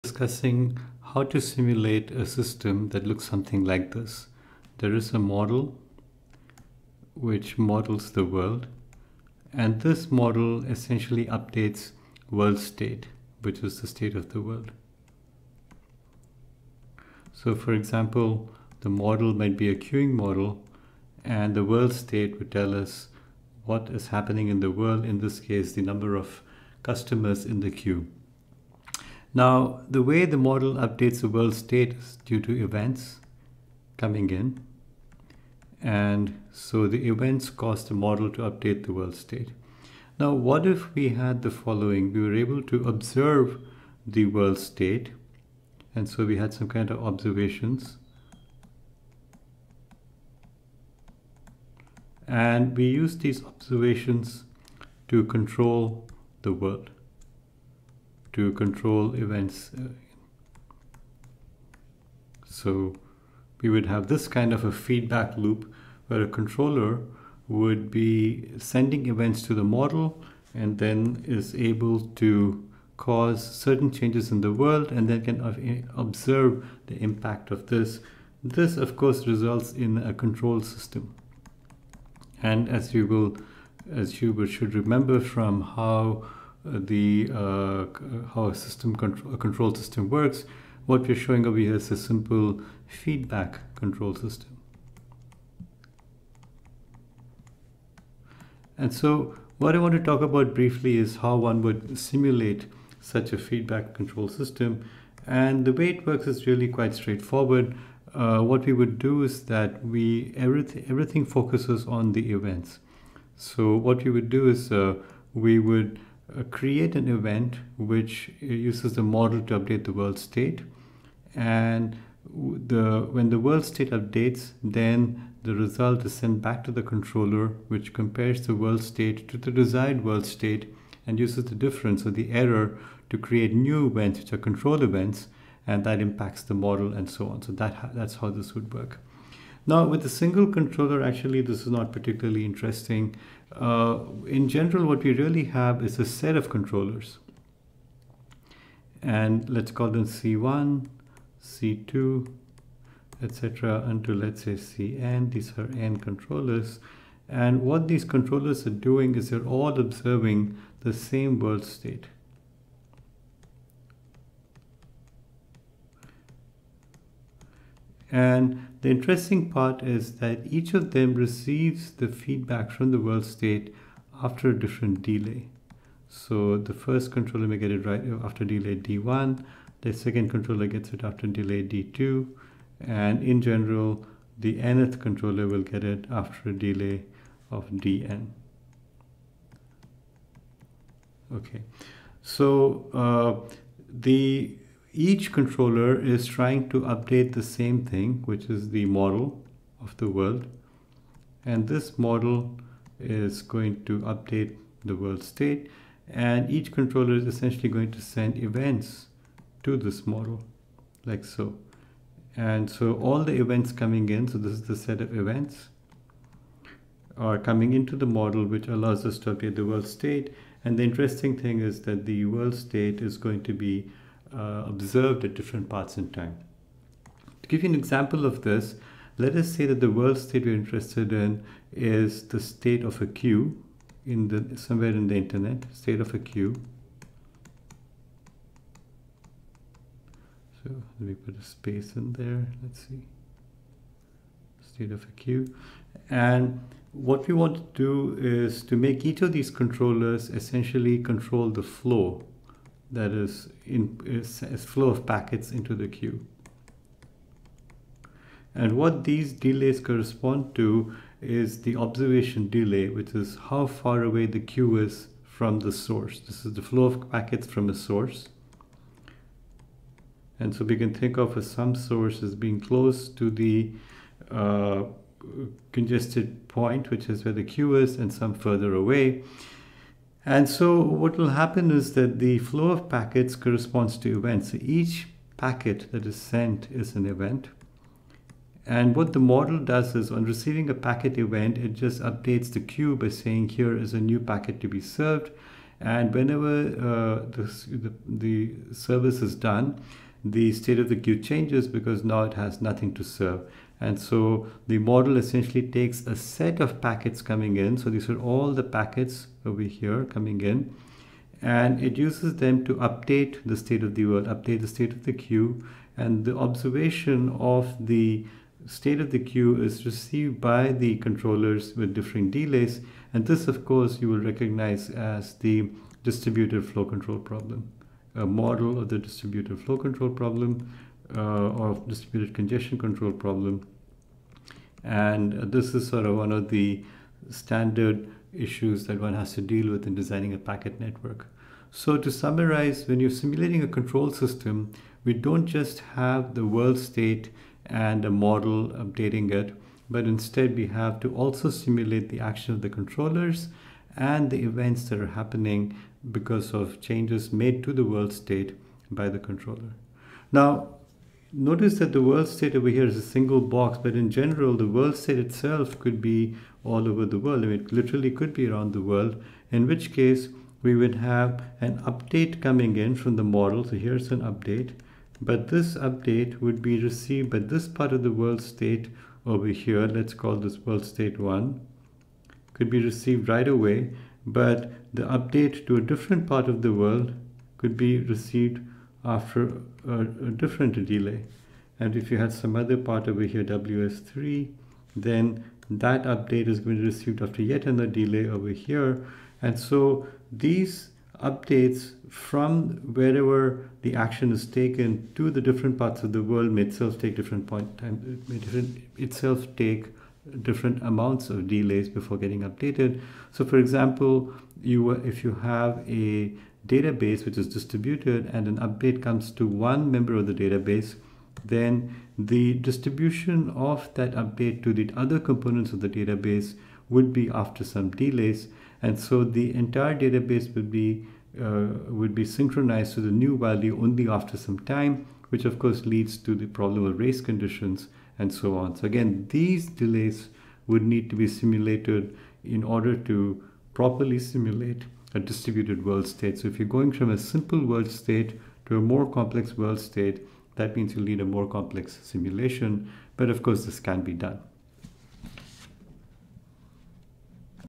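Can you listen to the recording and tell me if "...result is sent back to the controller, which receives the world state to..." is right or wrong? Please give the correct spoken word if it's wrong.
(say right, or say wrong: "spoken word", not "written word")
wrong: "compares", not "receives".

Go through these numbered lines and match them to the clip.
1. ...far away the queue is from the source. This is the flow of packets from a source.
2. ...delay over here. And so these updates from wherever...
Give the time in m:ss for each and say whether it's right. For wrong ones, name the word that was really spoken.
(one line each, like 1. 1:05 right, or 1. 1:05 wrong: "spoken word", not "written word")
1. 4:23 right
2. 6:37 right.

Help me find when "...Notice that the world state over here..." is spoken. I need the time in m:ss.
6:01.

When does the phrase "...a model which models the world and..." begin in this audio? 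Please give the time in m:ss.
0:05.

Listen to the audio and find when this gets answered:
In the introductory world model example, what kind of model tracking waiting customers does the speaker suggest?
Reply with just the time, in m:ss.
0:19.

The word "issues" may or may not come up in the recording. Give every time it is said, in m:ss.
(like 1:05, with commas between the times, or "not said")
5:38.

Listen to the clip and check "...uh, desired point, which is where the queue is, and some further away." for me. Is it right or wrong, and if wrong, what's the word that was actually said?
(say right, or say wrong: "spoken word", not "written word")
wrong: "congested", not "desired".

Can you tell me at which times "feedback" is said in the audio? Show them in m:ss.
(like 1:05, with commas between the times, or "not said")
1:04, 1:32, 1:43, 2:52.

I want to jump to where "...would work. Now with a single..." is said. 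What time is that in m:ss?
2:18.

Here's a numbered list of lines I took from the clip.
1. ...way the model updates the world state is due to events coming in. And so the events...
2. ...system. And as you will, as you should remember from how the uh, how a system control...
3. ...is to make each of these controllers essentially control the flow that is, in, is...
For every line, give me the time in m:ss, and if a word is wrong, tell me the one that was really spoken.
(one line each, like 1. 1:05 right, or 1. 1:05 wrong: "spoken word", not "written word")
1. 0:30 right
2. 1:20 right
3. 4:08 right.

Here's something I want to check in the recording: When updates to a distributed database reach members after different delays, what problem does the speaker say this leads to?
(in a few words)
Race conditions.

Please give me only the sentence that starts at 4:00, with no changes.
So let me put a space in there.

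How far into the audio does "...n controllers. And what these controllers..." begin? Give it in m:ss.
2:35.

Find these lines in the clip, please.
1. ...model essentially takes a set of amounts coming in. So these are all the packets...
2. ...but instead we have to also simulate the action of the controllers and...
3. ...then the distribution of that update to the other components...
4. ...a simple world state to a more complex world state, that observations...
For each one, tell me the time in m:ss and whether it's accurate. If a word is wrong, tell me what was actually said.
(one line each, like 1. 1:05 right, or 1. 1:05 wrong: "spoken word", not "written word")
1. 5:04 wrong: "packets", not "amounts"
2. 5:49 right
3. 7:01 right
4. 7:27 wrong: "means", not "observations".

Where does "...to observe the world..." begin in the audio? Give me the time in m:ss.
0:42.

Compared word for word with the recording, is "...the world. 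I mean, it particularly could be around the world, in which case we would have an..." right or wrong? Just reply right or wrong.
wrong.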